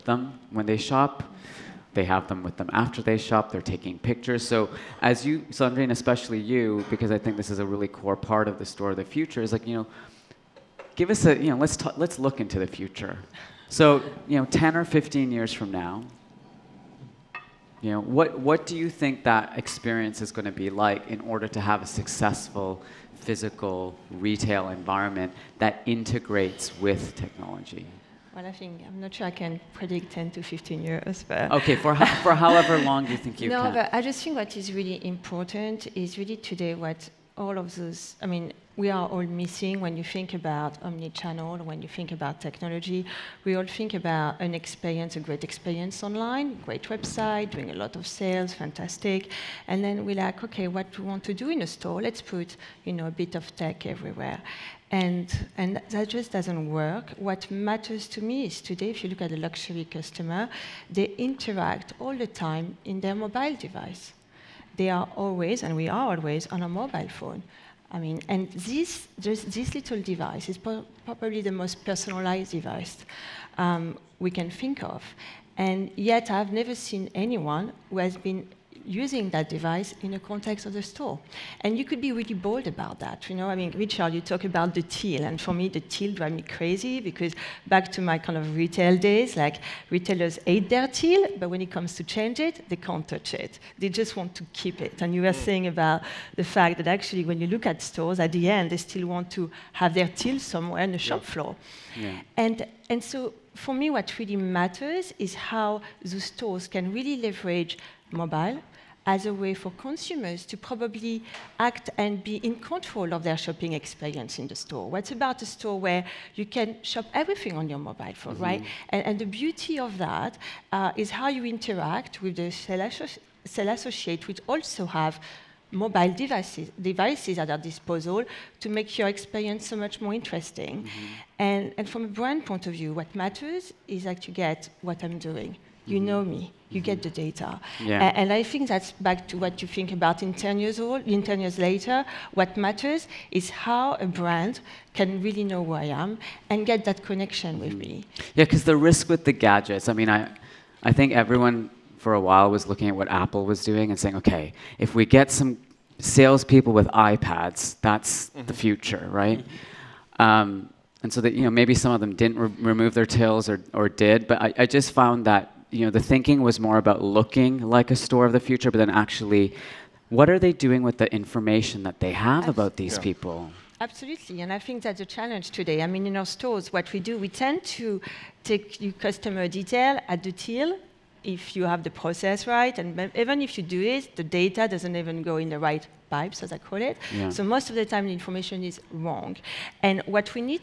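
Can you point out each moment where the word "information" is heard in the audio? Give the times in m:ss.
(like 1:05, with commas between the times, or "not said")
2:51, 3:08.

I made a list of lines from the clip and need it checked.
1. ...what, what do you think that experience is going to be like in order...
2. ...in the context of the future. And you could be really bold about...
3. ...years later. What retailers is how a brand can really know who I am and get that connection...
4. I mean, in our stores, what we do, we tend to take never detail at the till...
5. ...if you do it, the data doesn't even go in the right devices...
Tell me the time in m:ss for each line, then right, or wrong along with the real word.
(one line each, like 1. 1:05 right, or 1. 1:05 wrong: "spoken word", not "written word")
1. 0:18 right
2. 1:20 wrong: "store", not "future"
3. 2:21 wrong: "matters", not "retailers"
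4. 2:55 wrong: "customer", not "never"
5. 3:03 wrong: "pipes", not "devices".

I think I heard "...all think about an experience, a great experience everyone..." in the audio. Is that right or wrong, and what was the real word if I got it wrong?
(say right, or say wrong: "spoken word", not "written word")
wrong: "online", not "everyone".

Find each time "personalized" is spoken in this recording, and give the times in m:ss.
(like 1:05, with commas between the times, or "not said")
1:11.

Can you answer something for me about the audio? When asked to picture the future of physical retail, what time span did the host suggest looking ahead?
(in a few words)
10 or 15 years.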